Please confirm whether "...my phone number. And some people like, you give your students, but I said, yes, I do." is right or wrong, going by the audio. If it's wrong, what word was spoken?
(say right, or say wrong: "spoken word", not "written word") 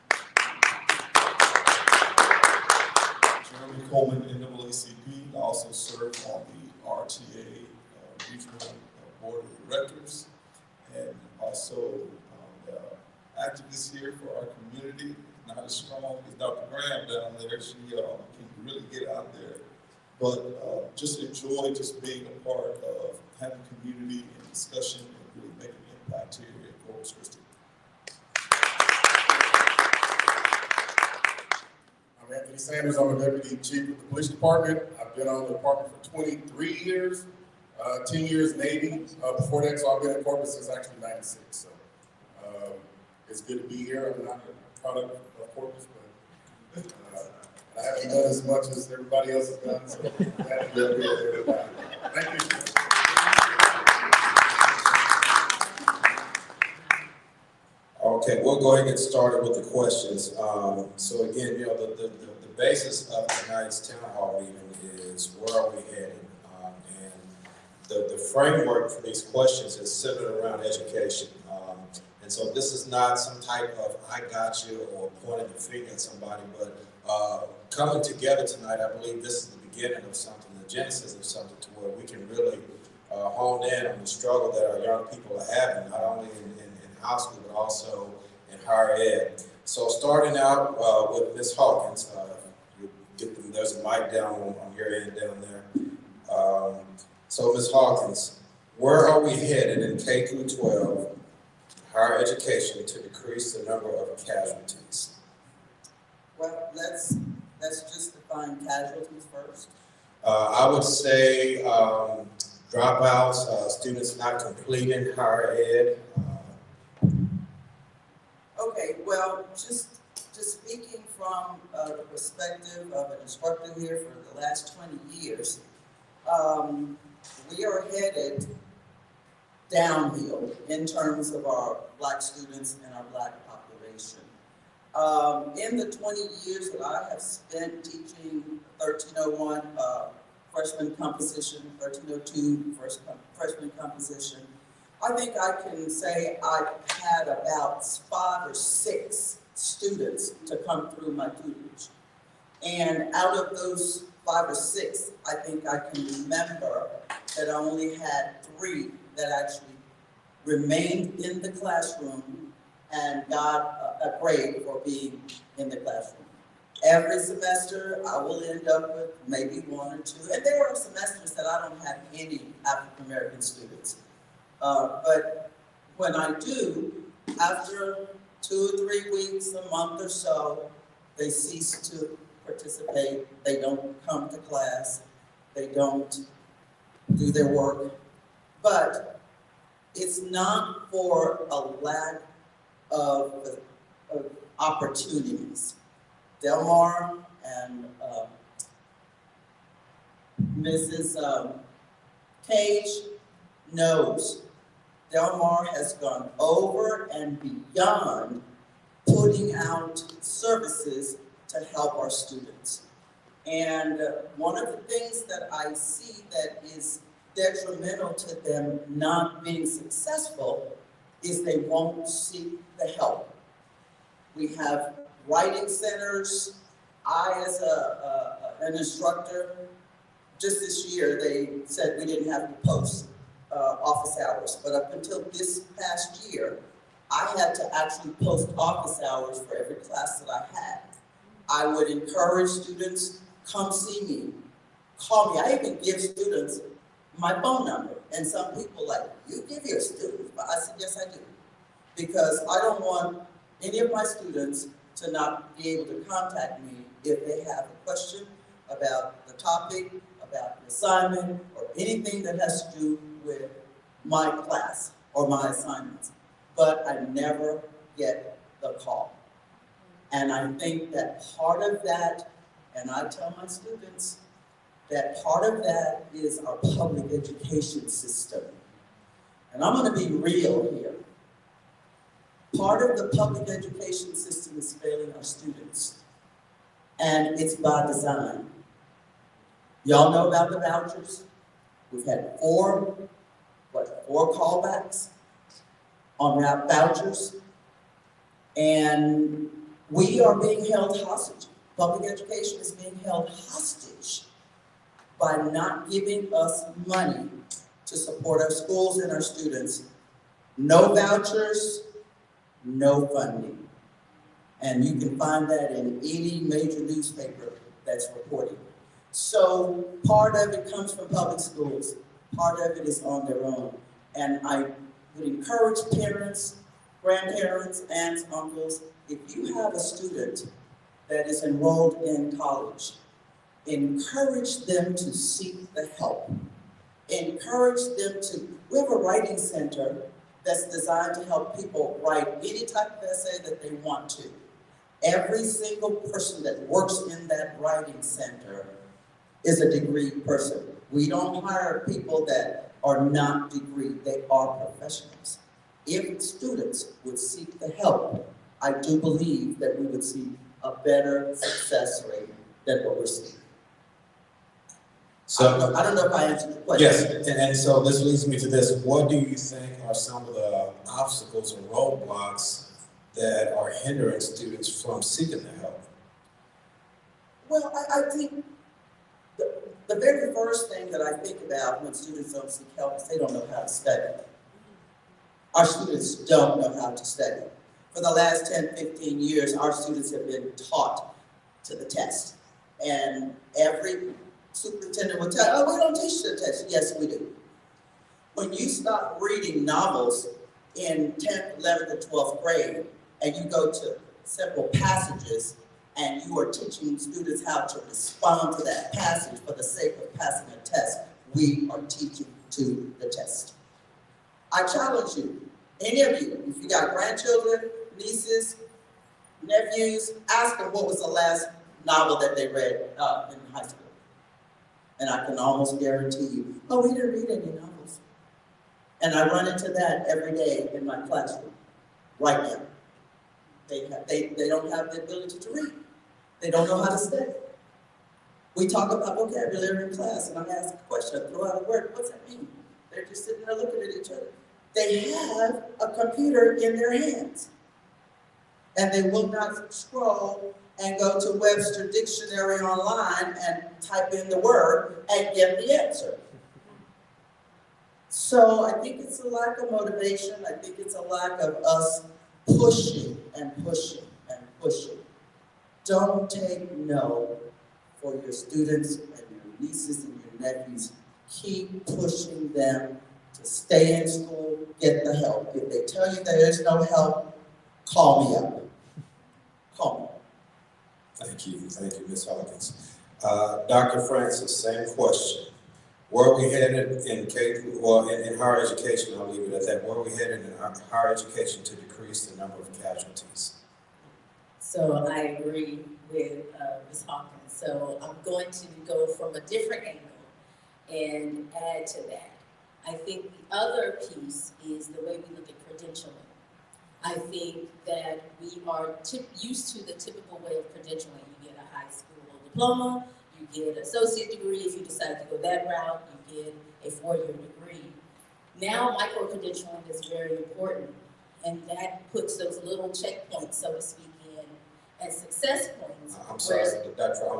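right.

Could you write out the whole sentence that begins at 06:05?
So, I don't know if I answered your question.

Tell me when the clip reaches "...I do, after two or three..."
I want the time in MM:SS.
02:56.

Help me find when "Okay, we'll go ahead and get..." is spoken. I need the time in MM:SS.
00:58.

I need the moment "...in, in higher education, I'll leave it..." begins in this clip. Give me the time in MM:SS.
08:08.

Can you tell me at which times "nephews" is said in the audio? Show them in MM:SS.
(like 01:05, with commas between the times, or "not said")
06:59, 07:50.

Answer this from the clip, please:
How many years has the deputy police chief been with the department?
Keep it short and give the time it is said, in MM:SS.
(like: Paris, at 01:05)
23, at 00:36.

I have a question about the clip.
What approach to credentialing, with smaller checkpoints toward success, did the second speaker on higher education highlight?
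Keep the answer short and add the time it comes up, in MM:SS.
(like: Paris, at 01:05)
micro-credentialing, at 08:38.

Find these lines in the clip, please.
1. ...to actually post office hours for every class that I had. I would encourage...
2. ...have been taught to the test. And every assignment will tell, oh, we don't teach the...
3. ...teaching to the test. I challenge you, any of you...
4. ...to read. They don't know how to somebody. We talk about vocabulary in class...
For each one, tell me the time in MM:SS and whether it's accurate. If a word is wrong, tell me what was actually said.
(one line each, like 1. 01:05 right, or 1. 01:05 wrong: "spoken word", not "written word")
1. 03:57 right
2. 06:30 wrong: "superintendent", not "assignment"
3. 06:51 right
4. 07:15 wrong: "study", not "somebody".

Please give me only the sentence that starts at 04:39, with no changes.
And I'm going to be real here.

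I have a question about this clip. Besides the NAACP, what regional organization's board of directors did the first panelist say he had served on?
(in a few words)
RTA.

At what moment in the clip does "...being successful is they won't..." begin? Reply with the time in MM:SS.
03:39.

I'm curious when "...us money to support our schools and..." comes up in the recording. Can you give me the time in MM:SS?
05:06.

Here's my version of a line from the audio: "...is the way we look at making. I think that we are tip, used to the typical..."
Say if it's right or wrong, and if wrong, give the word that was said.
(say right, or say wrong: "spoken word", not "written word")
wrong: "credentialing", not "making".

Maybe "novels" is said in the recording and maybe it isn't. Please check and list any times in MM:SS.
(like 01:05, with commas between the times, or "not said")
06:39, 07:01, 07:07.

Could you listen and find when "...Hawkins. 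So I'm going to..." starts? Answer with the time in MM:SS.
08:17.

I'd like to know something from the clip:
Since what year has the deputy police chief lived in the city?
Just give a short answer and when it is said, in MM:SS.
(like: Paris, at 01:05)
1996, at 00:41.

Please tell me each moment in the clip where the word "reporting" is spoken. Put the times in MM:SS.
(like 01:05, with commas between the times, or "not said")
05:18.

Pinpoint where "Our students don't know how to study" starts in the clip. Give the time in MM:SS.
06:25.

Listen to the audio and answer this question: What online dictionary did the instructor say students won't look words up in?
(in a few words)
Webster Dictionary.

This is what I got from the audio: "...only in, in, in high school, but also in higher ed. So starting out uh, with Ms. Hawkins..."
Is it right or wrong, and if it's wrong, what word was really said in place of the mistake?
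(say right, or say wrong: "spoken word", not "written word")
right.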